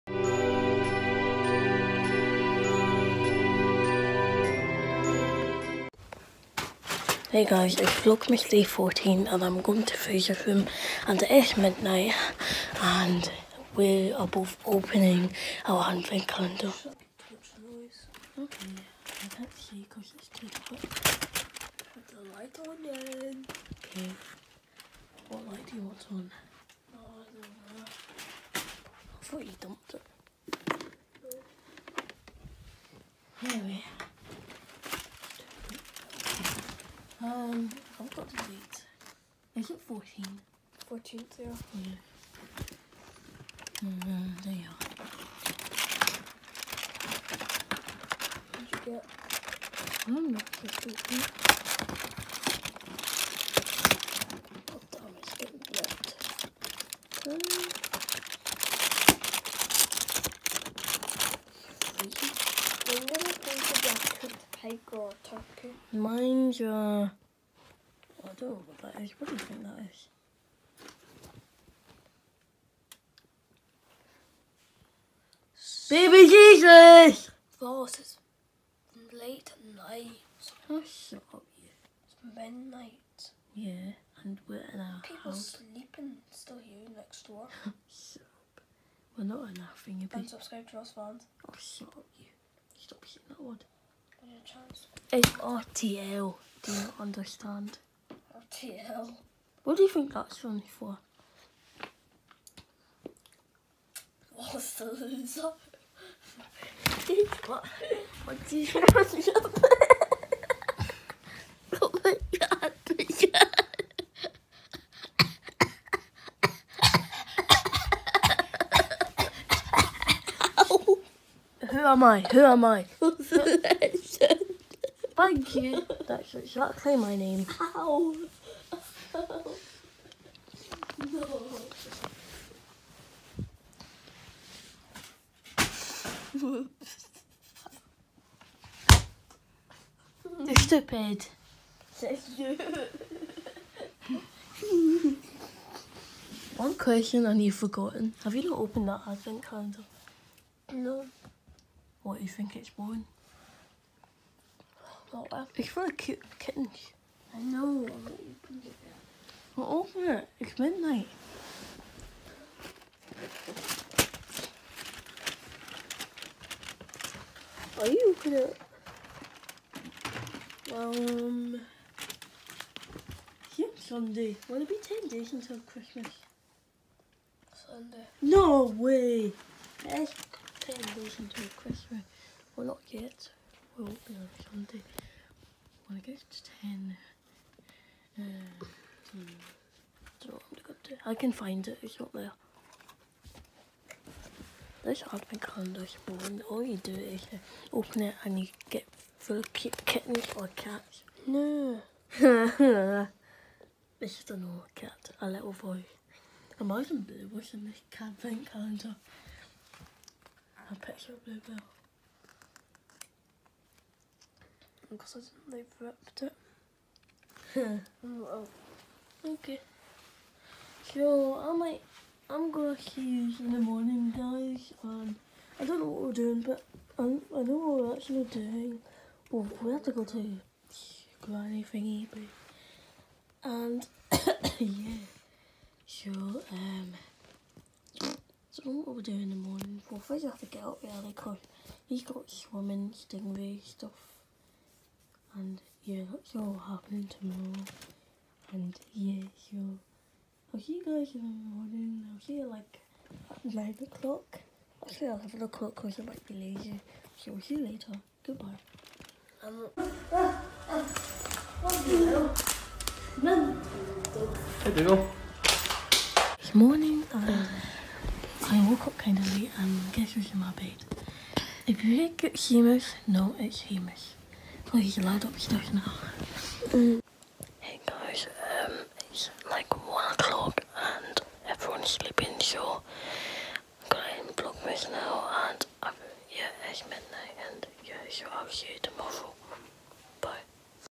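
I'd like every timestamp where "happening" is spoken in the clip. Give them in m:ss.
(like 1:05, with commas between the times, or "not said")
4:06.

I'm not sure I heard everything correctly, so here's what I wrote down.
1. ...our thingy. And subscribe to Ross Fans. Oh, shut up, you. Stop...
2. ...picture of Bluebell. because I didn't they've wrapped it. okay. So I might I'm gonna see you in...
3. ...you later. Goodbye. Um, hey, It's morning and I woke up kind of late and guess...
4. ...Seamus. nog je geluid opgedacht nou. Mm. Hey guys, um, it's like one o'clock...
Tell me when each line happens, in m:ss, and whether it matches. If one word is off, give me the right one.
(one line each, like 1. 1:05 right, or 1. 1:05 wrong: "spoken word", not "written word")
1. 1:29 right
2. 3:30 right
3. 4:17 right
4. 4:33 right.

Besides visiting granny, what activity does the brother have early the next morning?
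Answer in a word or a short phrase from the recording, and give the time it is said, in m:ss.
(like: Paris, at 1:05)
Swimming, at 4:02.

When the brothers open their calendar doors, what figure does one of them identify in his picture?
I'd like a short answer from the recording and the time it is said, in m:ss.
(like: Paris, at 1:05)
Baby Jesus, at 1:15.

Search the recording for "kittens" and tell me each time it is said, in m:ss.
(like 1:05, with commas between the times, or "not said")
2:36, 3:19.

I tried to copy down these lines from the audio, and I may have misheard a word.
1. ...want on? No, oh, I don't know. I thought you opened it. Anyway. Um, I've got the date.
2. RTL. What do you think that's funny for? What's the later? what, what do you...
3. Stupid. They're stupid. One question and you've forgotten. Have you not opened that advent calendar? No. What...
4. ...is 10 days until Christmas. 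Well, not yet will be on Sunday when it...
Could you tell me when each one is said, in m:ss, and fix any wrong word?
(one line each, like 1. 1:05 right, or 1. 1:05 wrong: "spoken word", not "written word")
1. 0:25 wrong: "dumped", not "opened"
2. 1:38 wrong: "loser", not "later"
3. 2:20 right
4. 2:59 right.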